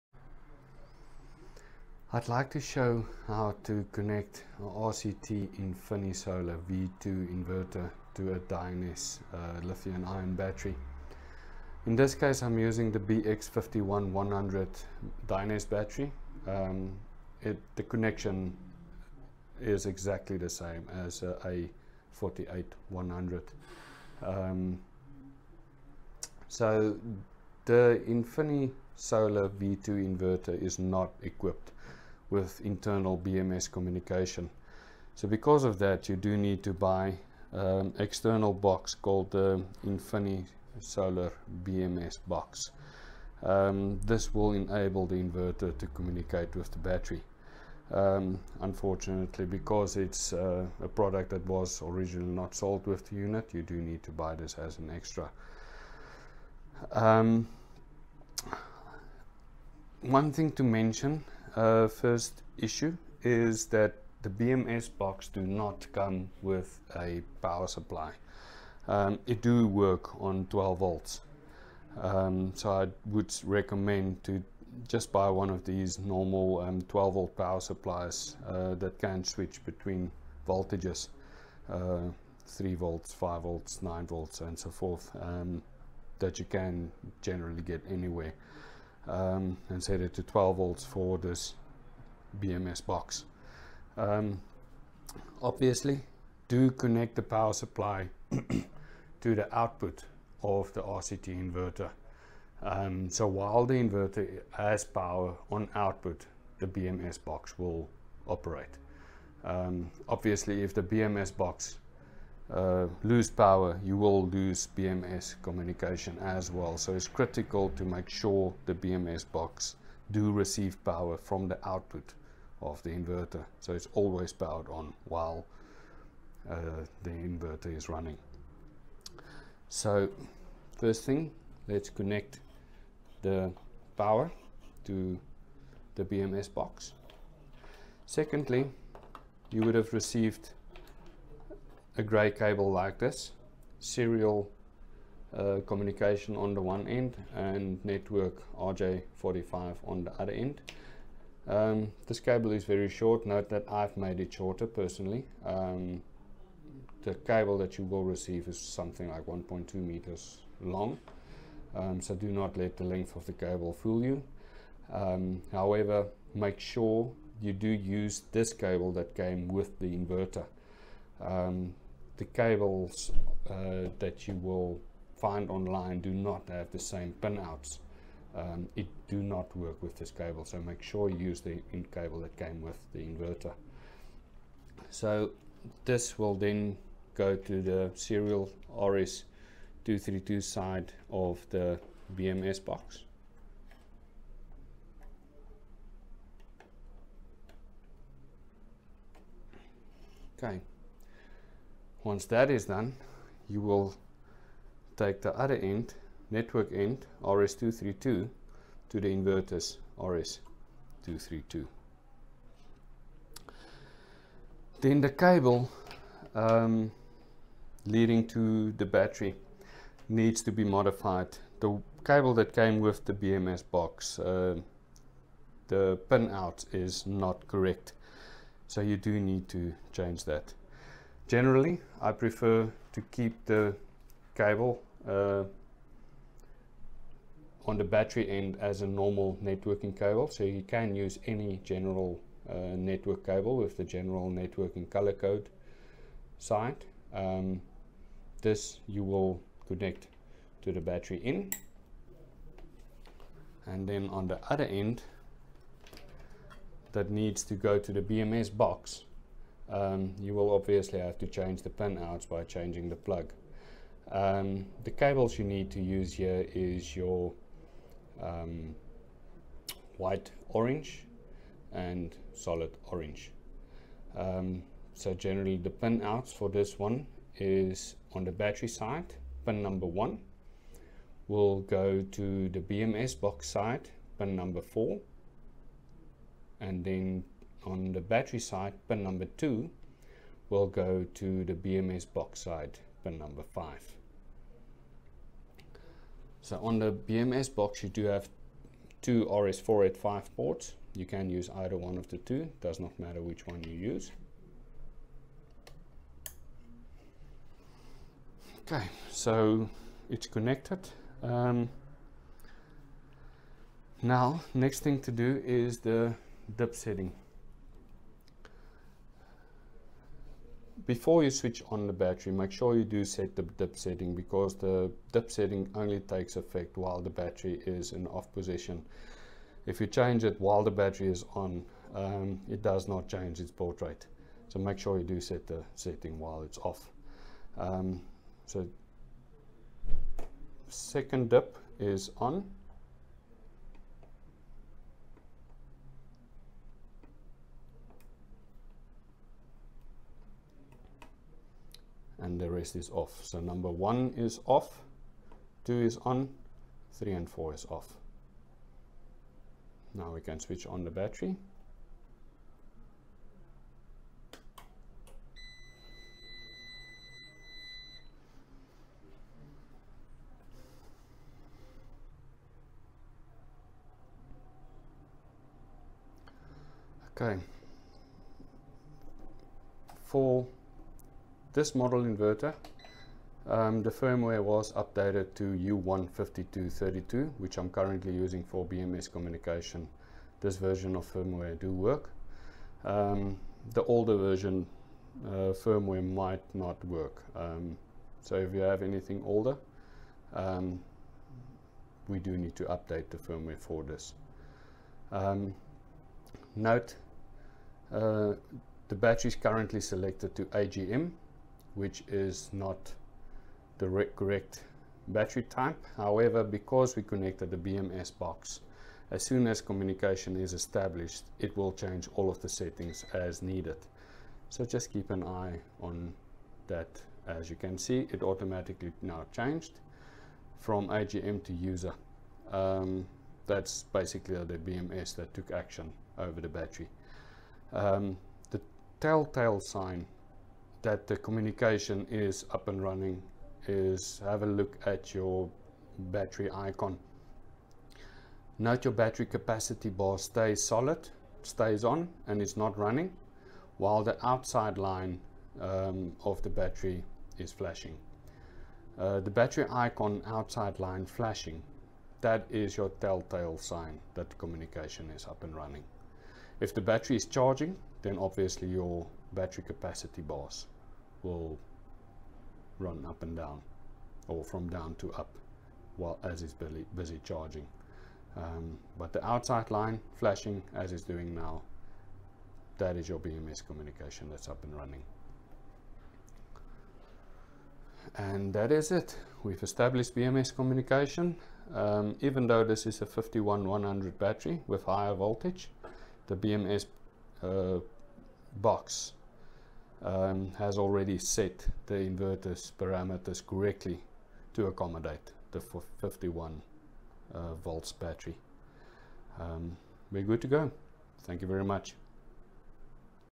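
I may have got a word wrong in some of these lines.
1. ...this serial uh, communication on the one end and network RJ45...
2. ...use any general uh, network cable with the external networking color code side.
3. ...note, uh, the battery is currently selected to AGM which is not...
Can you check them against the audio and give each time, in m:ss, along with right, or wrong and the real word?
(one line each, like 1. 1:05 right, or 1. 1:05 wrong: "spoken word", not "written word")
1. 2:22 right
2. 4:00 wrong: "general", not "external"
3. 6:46 right.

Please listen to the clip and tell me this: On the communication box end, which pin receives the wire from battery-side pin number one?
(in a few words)
4.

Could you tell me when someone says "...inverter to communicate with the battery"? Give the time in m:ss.
0:45.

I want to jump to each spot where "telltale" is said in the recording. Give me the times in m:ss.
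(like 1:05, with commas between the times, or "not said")
7:18, 7:42.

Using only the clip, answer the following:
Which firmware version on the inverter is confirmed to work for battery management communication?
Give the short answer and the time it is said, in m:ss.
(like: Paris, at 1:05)
U15232, at 6:25.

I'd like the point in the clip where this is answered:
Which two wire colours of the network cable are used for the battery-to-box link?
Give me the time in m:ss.
4:29.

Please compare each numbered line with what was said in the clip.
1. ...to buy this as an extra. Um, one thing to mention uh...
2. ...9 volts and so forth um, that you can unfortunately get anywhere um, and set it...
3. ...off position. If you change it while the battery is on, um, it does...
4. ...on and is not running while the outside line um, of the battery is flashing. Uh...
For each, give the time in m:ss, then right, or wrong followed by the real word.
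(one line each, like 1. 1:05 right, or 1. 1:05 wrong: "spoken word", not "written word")
1. 0:54 right
2. 1:23 wrong: "generally", not "unfortunately"
3. 5:28 right
4. 7:31 right.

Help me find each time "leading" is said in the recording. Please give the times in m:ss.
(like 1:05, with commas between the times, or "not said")
3:37.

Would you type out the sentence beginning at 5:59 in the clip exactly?
Now we can switch on the battery.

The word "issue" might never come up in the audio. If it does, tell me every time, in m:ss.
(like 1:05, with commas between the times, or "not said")
1:02.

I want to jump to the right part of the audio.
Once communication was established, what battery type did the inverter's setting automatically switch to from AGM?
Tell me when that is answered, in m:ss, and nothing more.
7:11.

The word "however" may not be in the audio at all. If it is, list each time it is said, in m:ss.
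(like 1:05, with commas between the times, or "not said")
2:45, 6:55.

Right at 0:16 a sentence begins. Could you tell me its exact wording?
Um, it, the connection is exactly the same as a A48100.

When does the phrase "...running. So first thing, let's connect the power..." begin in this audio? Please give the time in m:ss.
2:07.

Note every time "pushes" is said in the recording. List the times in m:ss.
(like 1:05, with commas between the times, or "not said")
not said.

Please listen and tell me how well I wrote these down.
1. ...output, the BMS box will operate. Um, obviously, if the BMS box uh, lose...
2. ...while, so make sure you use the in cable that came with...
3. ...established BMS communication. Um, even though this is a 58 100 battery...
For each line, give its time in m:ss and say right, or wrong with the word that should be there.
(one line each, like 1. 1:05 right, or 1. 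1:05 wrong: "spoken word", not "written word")
1. 1:45 right
2. 3:00 wrong: "cable", not "while"
3. 8:09 wrong: "51", not "58".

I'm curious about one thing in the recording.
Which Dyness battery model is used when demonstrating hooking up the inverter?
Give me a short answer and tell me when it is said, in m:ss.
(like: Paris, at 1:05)
BX51100, at 0:12.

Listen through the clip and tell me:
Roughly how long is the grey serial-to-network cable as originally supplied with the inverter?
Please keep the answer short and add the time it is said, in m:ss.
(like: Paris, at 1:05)
1.2 meters, at 2:39.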